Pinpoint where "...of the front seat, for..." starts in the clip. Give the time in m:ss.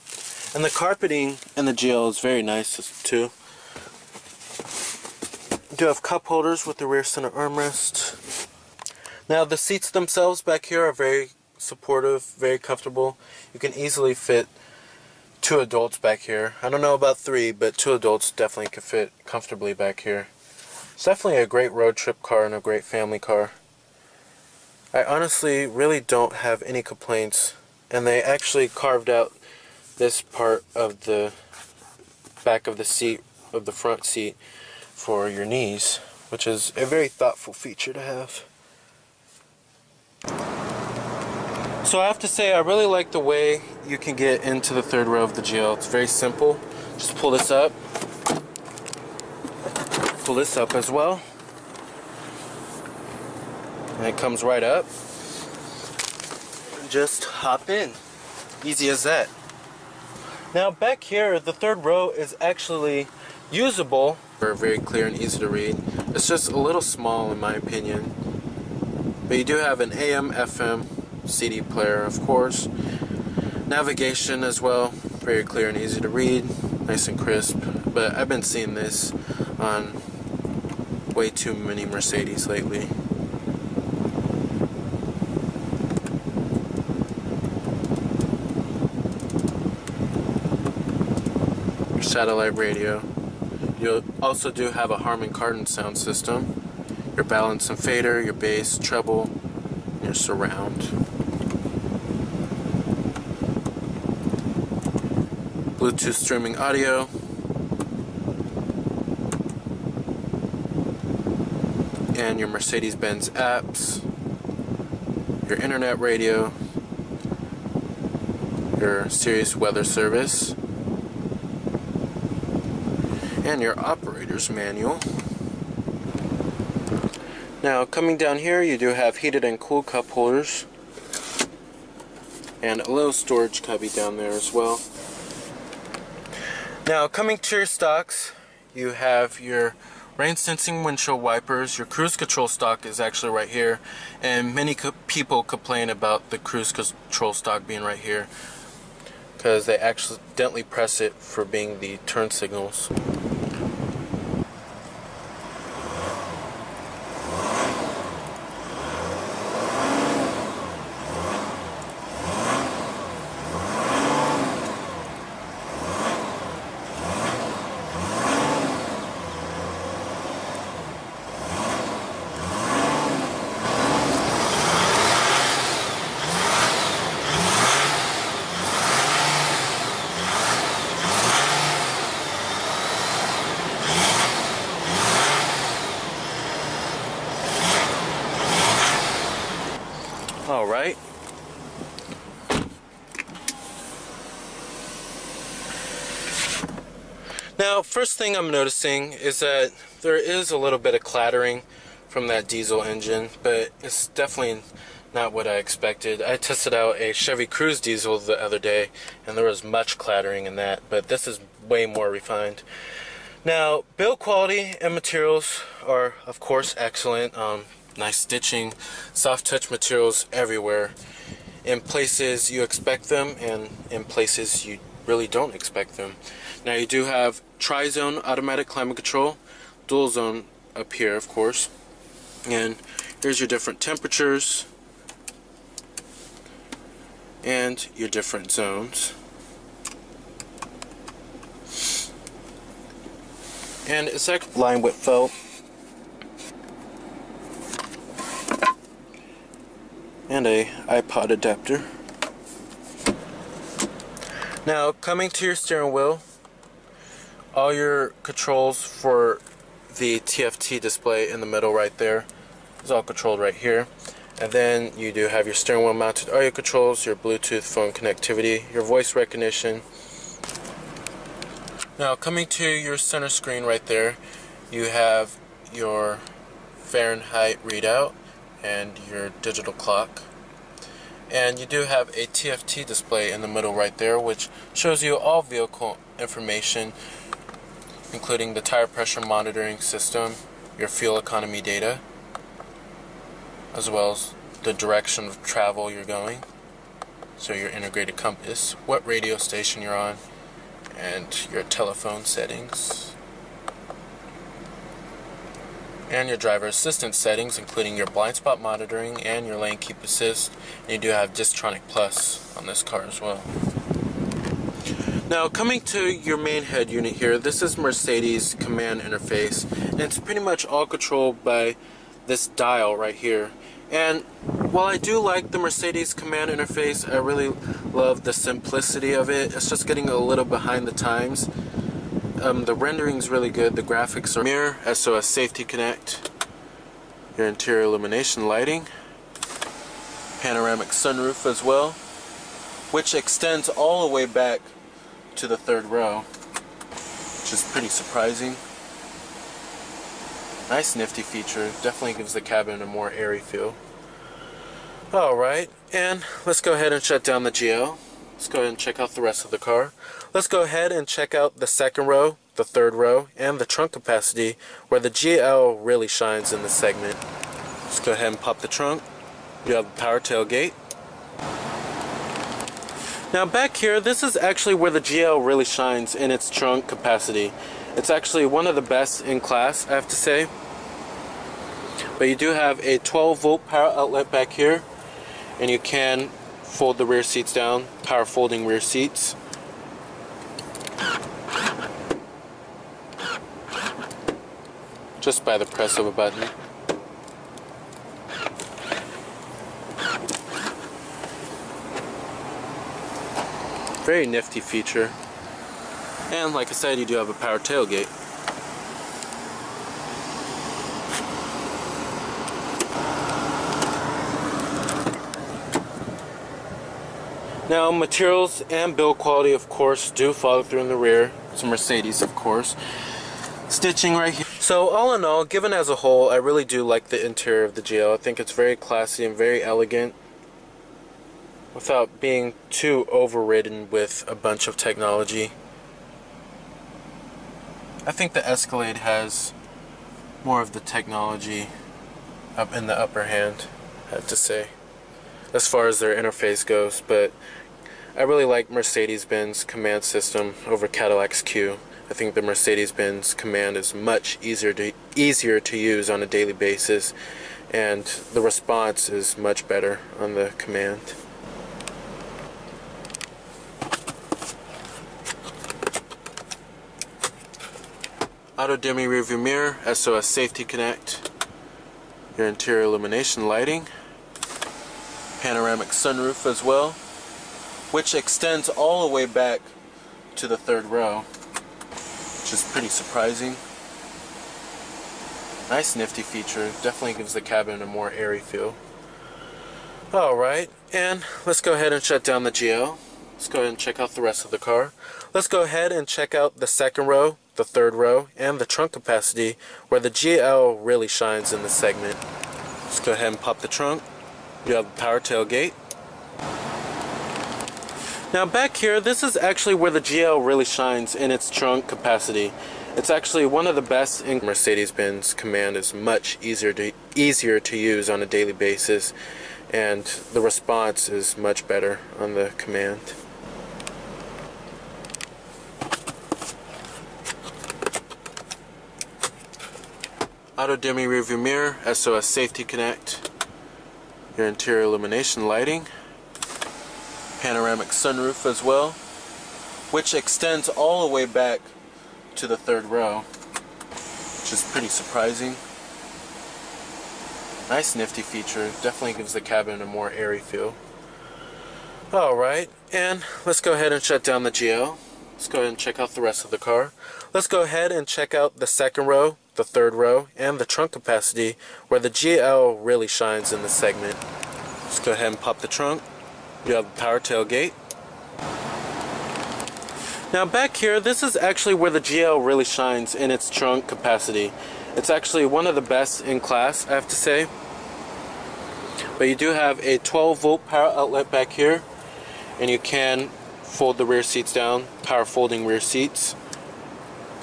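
0:33.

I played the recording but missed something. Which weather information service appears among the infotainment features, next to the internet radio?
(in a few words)
Sirius Weather Service.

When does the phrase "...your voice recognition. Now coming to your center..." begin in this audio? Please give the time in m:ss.
4:28.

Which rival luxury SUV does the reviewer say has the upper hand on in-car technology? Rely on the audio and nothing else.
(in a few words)
Escalade.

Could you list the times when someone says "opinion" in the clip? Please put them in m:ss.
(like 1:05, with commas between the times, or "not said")
1:07.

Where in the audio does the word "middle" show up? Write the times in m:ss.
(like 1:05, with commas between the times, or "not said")
4:21, 4:43.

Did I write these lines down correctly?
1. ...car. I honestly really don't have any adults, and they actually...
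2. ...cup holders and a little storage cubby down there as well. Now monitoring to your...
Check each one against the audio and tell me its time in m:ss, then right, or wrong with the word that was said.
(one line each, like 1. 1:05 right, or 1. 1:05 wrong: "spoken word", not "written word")
1. 0:23 wrong: "complaints", not "adults"
2. 2:09 wrong: "coming", not "monitoring".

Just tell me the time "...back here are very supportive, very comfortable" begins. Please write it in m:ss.
0:10.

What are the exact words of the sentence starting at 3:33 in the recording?
Now, build quality and materials are, of course, excellent.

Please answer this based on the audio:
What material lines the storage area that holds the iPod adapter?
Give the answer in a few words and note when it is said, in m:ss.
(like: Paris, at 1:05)
felt, at 4:04.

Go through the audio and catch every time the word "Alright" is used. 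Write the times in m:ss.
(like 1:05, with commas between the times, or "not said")
5:55, 8:10, 9:12.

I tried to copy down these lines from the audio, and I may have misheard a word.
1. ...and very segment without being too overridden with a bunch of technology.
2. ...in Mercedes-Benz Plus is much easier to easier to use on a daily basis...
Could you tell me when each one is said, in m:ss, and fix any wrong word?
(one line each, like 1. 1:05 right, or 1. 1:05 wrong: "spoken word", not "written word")
1. 7:09 wrong: "elegant", not "segment"
2. 8:34 wrong: "COMAND", not "Plus".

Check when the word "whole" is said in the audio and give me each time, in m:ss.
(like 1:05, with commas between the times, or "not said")
7:05.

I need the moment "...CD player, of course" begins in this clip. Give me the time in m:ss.
1:11.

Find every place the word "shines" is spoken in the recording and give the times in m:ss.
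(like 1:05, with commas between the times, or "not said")
6:06, 6:15, 8:21, 8:30, 9:23, 9:32.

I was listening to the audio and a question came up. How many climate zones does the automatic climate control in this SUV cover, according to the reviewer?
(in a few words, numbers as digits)
tri-zone.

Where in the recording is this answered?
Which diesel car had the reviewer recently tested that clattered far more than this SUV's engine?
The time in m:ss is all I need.
3:27.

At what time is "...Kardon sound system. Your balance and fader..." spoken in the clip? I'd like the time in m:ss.
1:35.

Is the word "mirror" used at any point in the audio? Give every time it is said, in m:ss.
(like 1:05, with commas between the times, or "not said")
5:34, 7:49, 8:51.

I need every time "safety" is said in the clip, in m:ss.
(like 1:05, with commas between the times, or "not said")
5:35, 7:50, 8:52.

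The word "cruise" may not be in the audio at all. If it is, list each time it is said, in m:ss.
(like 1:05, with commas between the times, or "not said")
2:21, 2:26.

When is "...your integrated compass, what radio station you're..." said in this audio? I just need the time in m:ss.
4:57.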